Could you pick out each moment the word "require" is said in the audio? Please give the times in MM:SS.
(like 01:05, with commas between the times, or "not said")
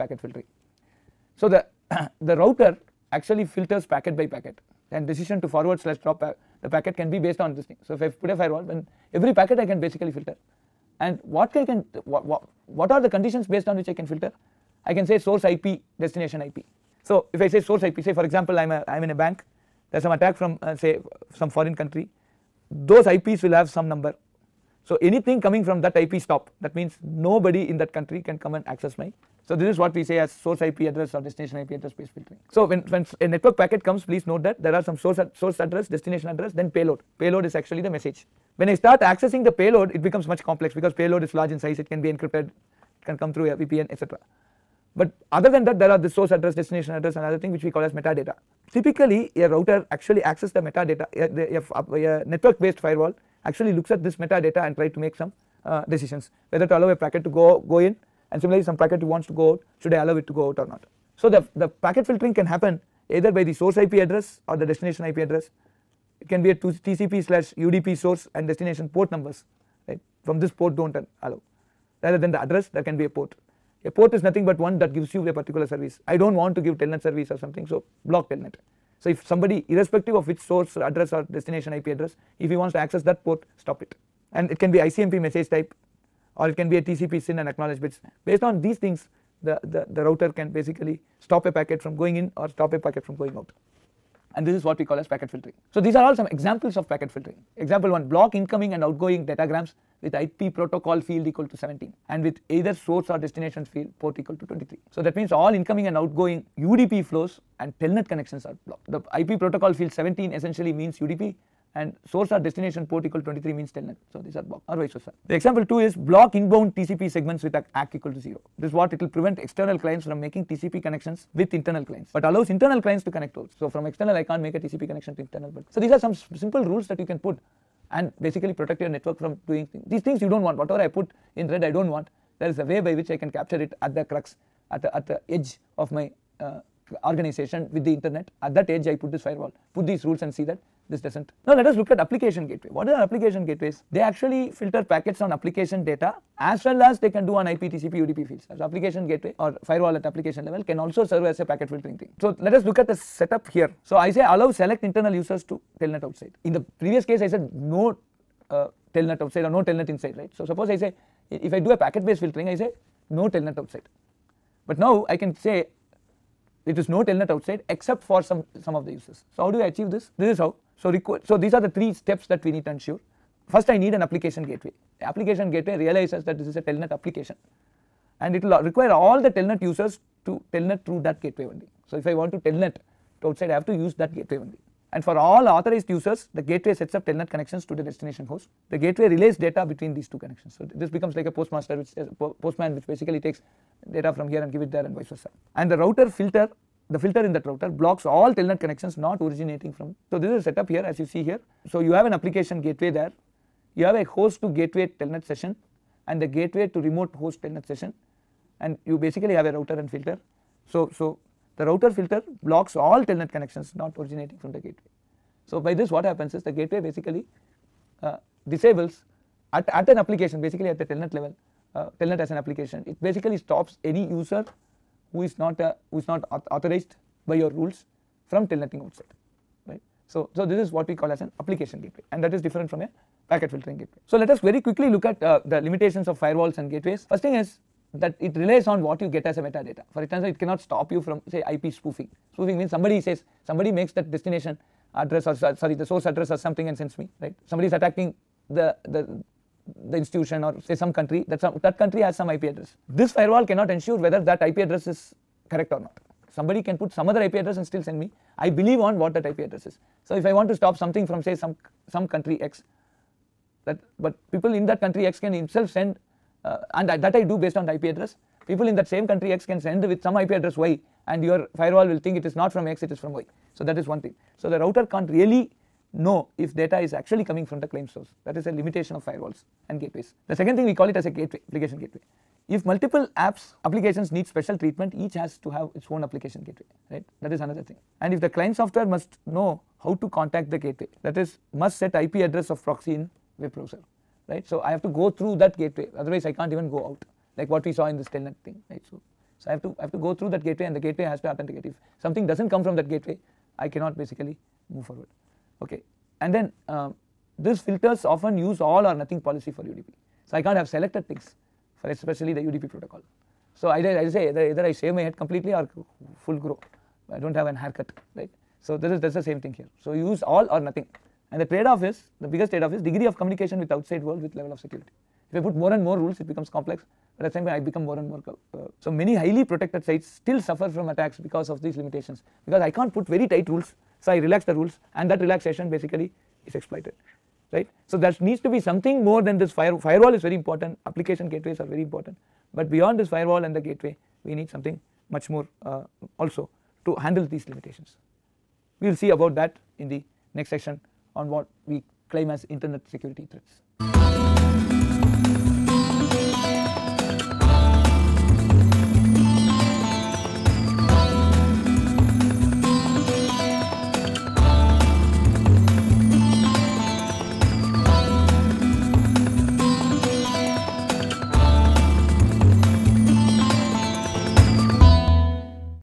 02:58.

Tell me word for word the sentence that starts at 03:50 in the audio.
So, so this is what we call as an application gateway and that is different from a packet filtering gateway.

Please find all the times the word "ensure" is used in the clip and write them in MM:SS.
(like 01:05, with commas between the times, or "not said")
02:52, 04:13.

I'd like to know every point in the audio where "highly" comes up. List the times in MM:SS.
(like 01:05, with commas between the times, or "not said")
05:29.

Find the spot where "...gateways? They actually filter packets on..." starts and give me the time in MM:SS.
02:23.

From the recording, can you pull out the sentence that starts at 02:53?
First I need an application gateway.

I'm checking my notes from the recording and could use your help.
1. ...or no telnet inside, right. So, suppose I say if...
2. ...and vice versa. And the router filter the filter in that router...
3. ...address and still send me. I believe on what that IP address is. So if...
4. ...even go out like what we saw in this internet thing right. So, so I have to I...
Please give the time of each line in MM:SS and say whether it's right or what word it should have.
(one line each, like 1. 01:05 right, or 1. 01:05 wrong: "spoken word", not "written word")
1. 02:39 right
2. 03:14 right
3. 04:17 right
4. 04:56 wrong: "telnet", not "internet".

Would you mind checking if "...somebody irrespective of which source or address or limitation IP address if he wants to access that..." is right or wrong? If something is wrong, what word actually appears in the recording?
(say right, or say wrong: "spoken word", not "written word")
wrong: "destination", not "limitation".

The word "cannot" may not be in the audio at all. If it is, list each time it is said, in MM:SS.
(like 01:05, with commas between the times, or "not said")
04:00, 04:13, 05:03.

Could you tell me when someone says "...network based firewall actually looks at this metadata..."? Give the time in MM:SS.
00:52.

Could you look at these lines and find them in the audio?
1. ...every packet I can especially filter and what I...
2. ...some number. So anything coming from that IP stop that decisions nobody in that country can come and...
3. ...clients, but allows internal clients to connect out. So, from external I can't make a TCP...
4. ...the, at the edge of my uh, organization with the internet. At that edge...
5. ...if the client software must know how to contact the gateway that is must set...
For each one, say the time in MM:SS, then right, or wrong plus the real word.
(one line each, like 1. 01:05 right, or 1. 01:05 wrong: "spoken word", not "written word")
1. 00:09 wrong: "basically", not "especially"
2. 00:23 wrong: "means", not "decisions"
3. 02:01 right
4. 02:14 right
5. 04:48 right.